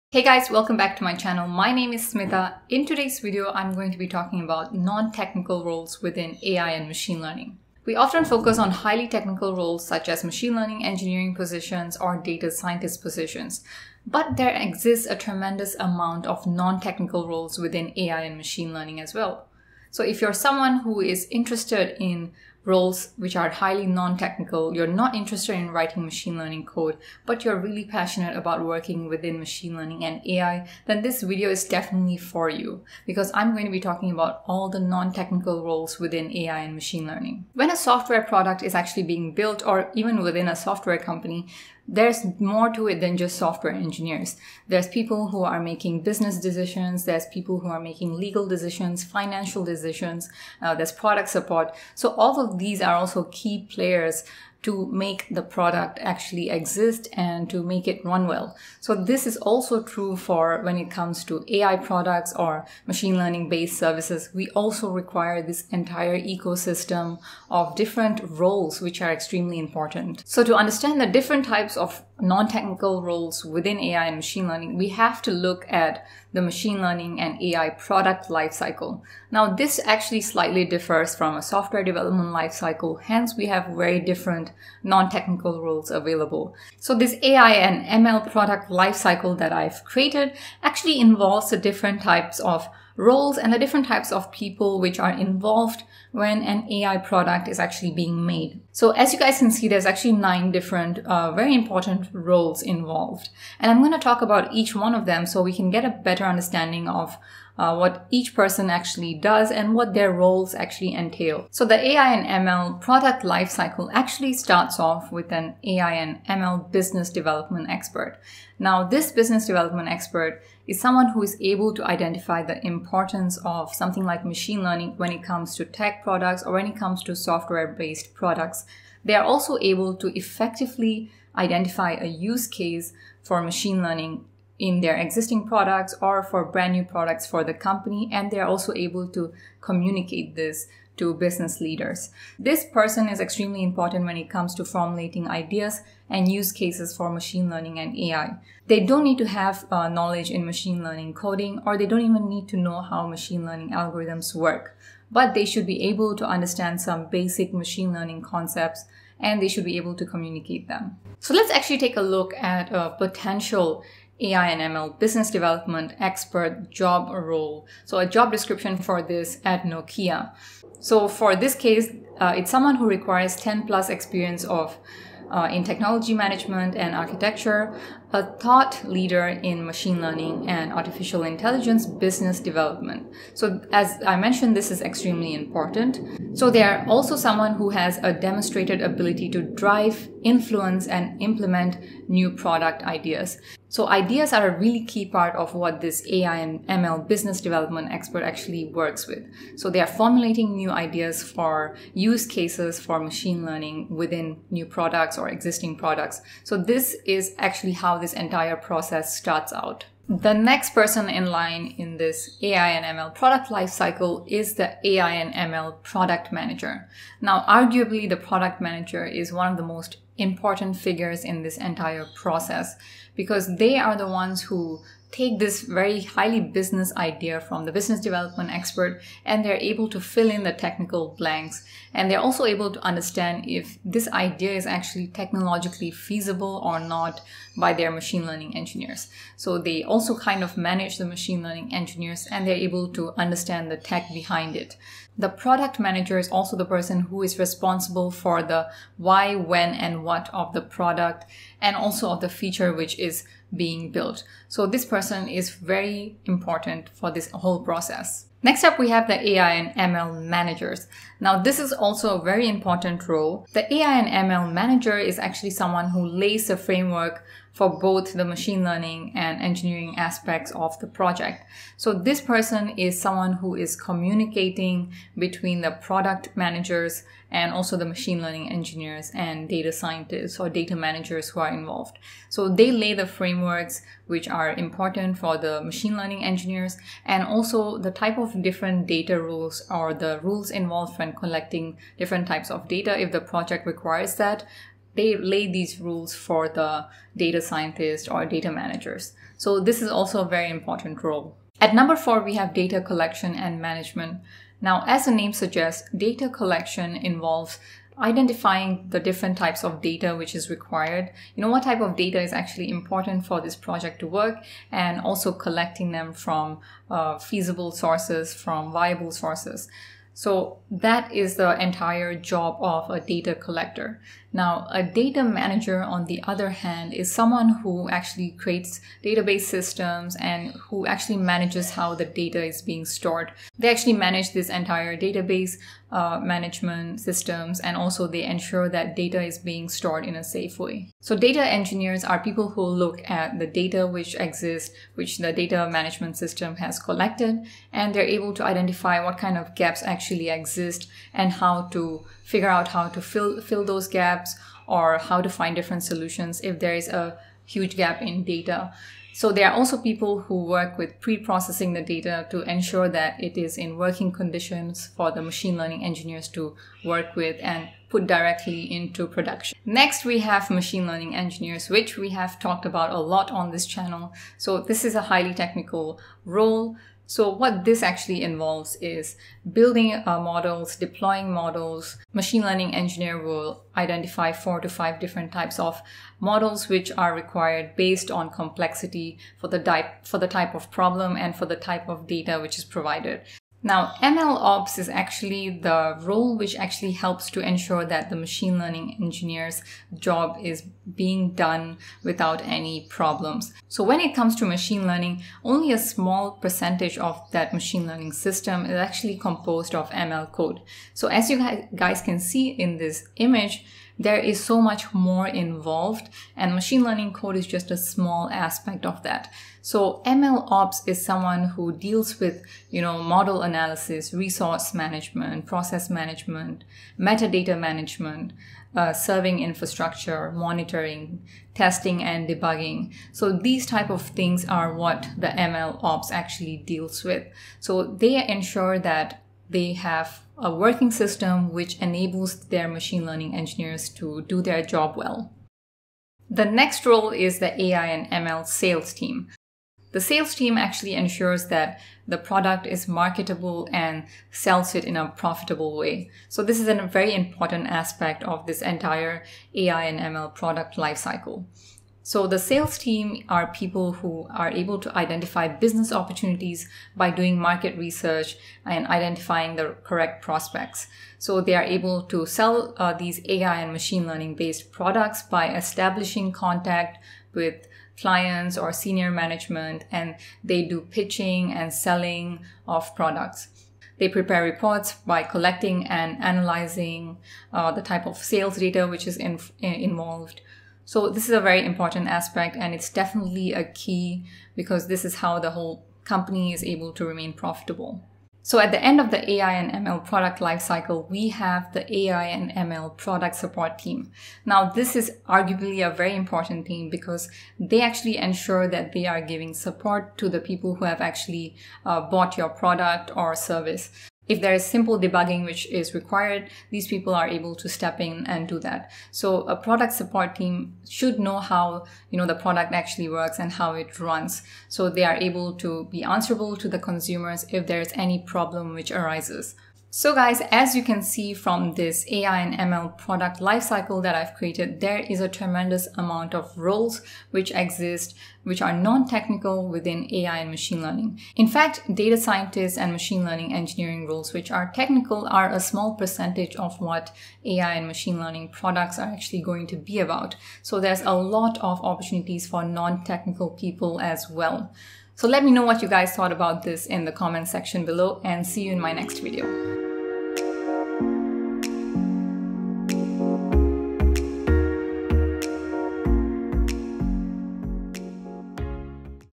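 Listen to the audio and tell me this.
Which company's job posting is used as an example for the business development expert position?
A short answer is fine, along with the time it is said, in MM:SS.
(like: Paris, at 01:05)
Nokia, at 02:49.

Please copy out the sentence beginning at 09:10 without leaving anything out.
So there's a lot of opportunities for non-technical people as well.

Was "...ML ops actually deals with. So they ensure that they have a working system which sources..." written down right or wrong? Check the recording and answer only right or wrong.
wrong.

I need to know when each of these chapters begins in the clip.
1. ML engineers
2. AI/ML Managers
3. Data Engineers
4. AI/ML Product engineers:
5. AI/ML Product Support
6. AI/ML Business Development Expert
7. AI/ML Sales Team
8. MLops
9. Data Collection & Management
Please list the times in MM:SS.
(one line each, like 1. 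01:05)
1. 06:10
2. 04:18
3. 05:40
4. 03:30
5. 08:18
6. 01:51
7. 07:26
8. 06:33
9. 05:01.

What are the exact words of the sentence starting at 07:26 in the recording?
The next role is the AI and ML sales team.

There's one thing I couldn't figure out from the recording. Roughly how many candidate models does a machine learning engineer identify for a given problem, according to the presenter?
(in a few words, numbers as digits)
4 to 5.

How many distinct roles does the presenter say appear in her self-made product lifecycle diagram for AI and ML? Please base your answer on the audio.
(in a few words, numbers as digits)
9.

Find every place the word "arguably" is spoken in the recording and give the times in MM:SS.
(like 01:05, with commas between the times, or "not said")
03:37, 08:25.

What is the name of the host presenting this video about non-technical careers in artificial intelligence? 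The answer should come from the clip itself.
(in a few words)
Smitha.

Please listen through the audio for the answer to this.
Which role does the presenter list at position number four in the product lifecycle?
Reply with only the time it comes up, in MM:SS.
05:02.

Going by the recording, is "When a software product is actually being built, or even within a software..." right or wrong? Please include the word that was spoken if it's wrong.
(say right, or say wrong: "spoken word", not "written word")
right.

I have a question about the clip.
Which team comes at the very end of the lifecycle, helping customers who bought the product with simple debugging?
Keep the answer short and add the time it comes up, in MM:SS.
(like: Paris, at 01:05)
AI and ML product support team, at 08:21.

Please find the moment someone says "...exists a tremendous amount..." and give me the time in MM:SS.
00:14.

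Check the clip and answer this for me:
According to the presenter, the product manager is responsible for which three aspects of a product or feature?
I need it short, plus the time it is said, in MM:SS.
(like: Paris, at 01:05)
why, when, and what, at 04:08.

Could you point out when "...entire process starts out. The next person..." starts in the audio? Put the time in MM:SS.
03:28.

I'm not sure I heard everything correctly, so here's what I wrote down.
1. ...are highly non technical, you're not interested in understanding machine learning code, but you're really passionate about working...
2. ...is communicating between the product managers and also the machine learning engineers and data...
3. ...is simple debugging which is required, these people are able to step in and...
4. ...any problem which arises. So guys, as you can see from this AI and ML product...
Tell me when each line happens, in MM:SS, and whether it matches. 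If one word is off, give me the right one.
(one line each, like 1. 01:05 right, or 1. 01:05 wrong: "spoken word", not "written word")
1. 00:23 wrong: "writing", not "understanding"
2. 04:33 right
3. 08:34 right
4. 08:47 right.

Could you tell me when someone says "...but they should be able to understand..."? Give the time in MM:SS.
02:35.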